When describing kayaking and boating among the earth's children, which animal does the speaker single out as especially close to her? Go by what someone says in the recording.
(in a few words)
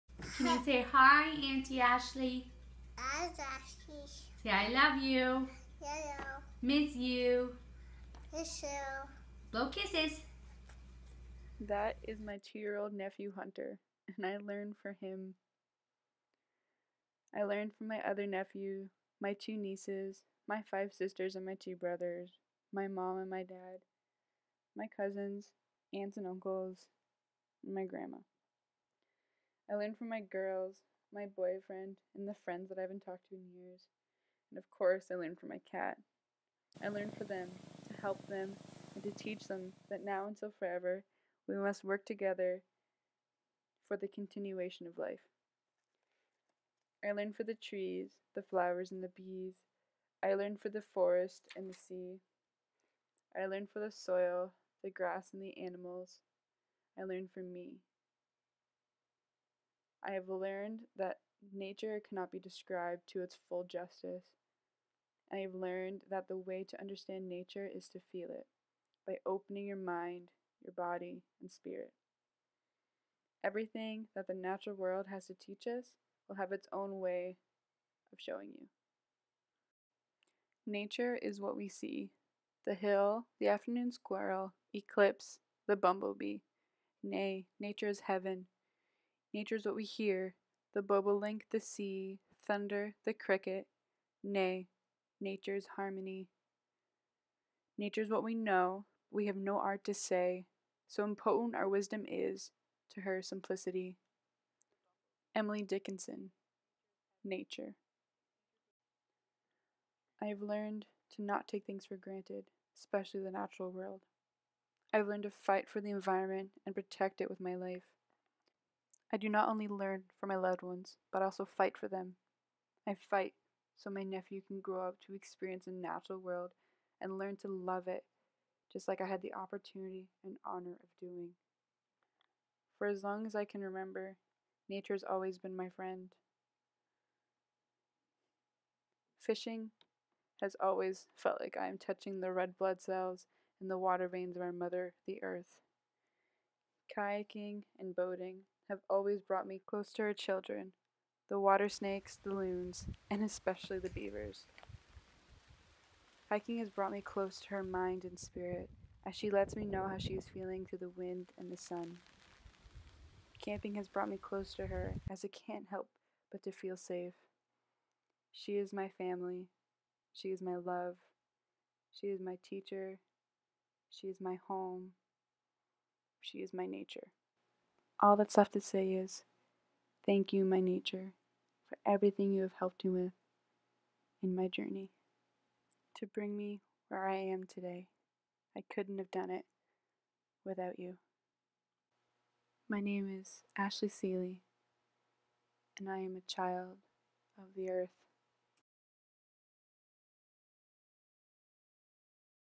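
beavers.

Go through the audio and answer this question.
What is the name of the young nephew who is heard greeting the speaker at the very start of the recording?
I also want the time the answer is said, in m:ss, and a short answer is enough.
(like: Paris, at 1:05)
Hunter, at 0:13.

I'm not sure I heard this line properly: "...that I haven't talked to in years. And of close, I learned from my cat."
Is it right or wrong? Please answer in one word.
wrong.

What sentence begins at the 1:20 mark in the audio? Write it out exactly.
Nature is what we see the hill, the afternoon squirrel, eclipse, the bumblebee.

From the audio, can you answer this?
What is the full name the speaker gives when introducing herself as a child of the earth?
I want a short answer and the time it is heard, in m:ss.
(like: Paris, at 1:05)
Ashley Seeley, at 3:13.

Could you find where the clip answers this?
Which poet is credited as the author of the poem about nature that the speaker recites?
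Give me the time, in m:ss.
1:45.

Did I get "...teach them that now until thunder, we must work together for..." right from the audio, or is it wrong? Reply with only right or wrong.
wrong.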